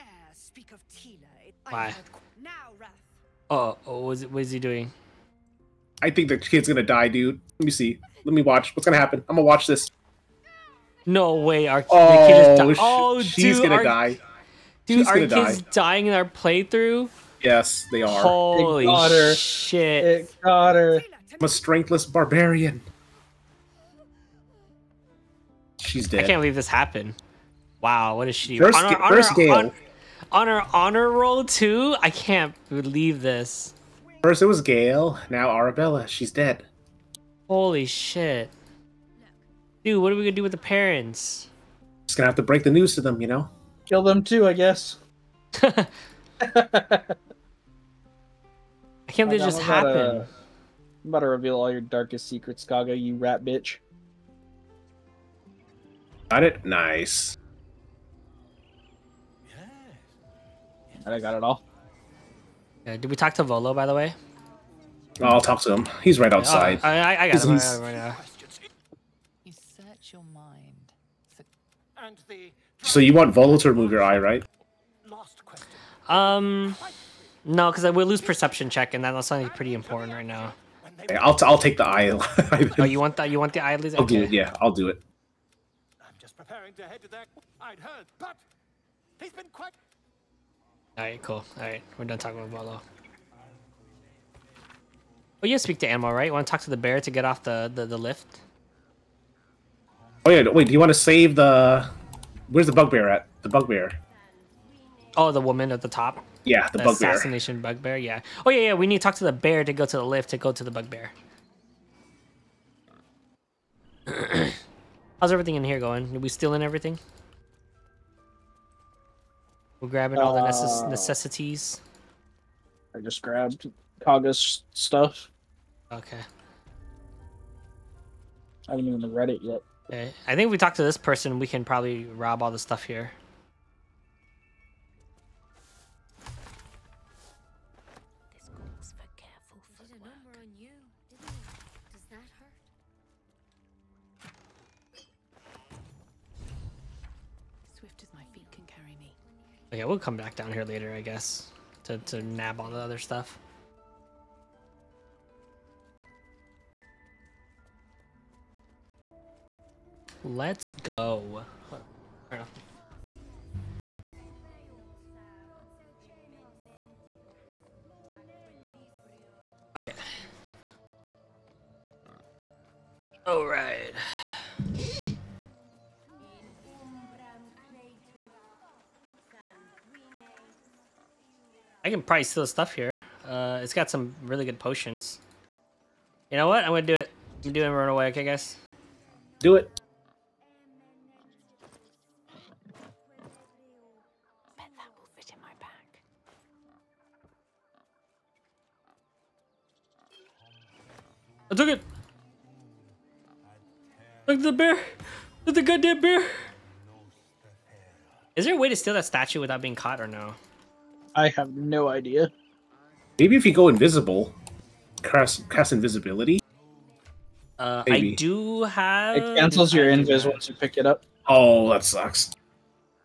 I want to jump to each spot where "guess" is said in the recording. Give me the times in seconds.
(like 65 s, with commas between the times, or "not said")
44 s, 151 s.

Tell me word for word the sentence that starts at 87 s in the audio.
I'd heard, but he's been quite.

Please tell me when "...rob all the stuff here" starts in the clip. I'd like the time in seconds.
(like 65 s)
132 s.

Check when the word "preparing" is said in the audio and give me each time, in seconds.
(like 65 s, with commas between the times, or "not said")
86 s.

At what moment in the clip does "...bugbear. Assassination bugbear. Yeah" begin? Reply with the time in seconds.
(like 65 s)
106 s.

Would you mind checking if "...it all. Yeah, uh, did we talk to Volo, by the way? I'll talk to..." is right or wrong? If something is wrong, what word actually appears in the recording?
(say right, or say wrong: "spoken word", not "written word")
right.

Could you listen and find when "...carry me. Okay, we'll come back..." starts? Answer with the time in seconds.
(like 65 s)
148 s.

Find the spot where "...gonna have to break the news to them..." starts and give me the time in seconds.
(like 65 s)
42 s.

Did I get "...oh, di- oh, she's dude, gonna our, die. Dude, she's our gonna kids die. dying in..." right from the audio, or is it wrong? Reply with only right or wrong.
right.